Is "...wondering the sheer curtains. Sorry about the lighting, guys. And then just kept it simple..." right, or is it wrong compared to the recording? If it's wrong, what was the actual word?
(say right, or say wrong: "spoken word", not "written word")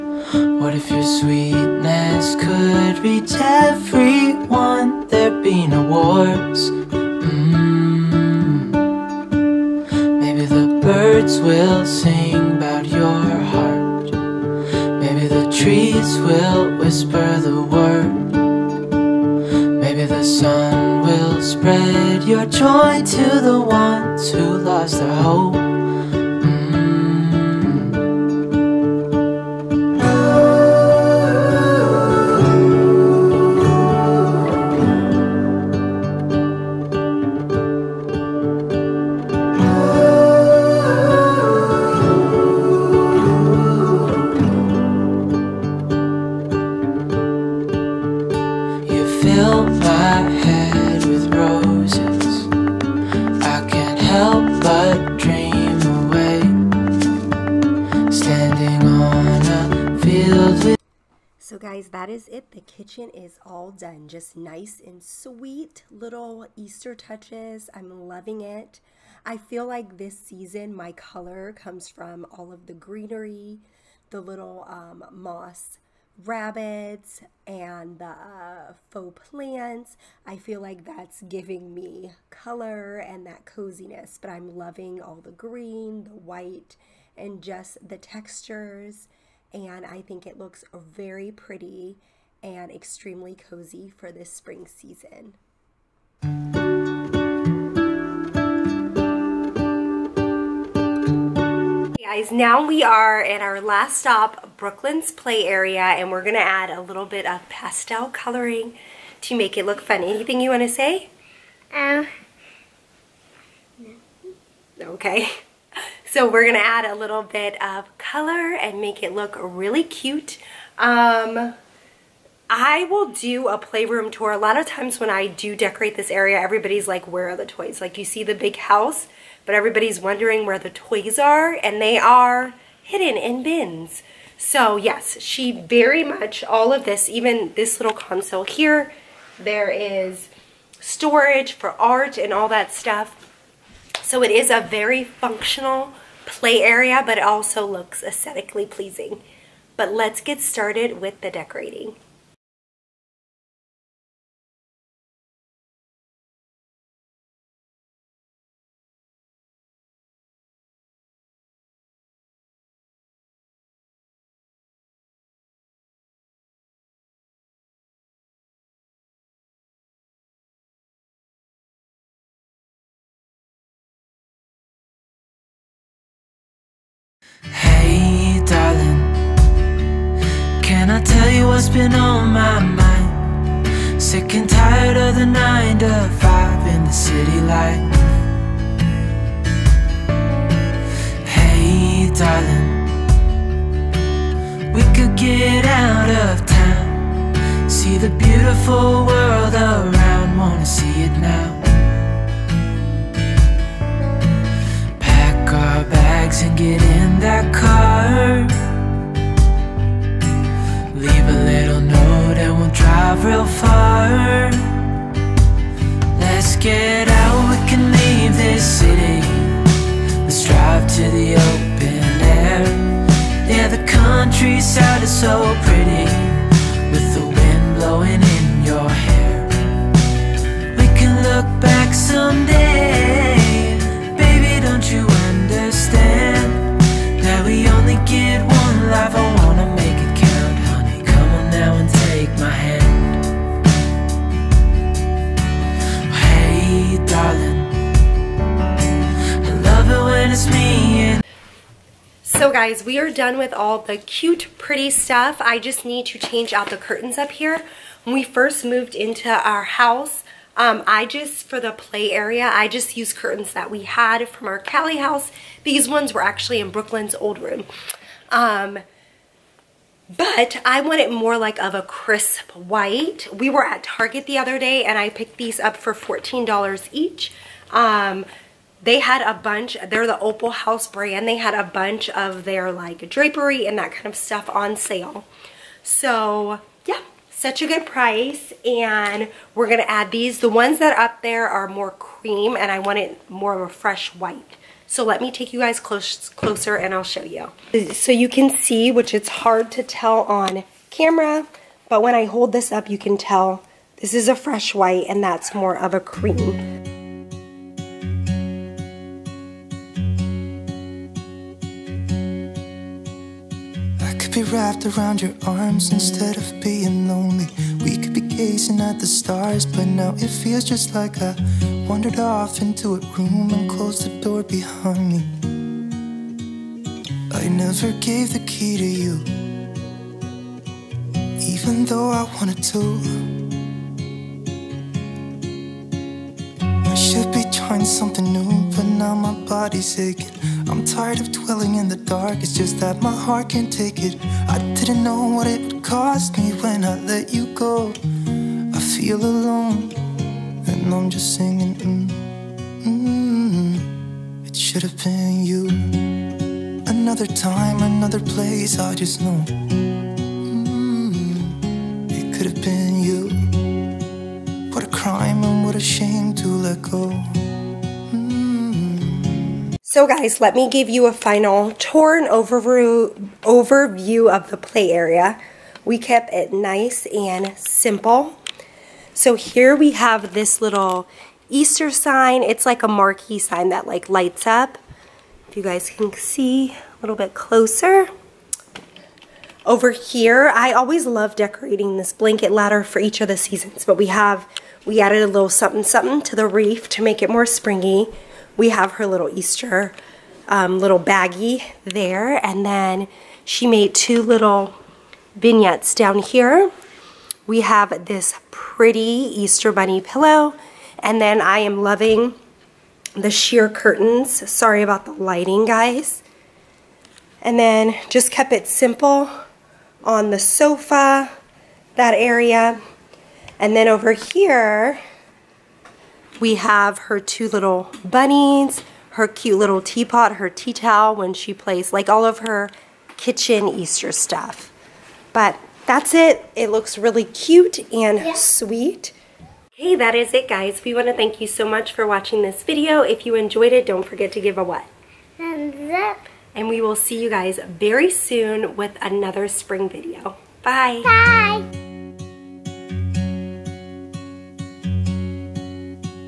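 wrong: "loving", not "wondering".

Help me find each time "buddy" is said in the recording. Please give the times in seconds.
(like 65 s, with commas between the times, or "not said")
not said.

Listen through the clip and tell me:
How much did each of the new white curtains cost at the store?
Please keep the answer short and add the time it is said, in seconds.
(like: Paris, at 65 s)
$14, at 275 s.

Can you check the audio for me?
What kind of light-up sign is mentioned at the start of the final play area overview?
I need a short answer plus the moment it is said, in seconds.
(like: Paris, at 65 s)
Marquee sign, at 382 s.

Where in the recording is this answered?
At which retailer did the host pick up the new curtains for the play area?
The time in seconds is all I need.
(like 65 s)
273 s.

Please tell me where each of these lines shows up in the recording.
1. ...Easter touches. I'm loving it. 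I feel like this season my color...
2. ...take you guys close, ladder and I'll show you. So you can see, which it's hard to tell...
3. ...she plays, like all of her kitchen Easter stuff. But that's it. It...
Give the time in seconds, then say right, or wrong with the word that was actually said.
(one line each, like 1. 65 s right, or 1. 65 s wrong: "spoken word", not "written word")
1. 66 s right
2. 295 s wrong: "closer", not "ladder"
3. 431 s right.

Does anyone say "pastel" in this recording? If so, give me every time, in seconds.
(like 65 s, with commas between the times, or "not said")
107 s.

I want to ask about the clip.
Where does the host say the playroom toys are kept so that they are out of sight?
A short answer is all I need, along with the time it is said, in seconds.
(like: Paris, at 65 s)
In bins, at 132 s.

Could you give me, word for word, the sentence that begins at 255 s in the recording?
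I just need to change out the curtains up here.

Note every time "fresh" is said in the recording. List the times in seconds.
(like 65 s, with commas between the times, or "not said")
293 s, 304 s.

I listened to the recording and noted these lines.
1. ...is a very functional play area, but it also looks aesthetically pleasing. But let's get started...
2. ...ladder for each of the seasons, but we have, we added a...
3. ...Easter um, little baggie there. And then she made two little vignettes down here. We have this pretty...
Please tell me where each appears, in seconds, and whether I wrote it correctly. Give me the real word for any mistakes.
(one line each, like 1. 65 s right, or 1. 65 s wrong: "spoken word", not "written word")
1. 144 s right
2. 392 s right
3. 399 s right.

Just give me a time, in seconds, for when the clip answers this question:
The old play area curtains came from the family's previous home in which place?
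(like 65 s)
264 s.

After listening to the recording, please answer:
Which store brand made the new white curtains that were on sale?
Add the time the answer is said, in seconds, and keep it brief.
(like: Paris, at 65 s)
Opal House, at 280 s.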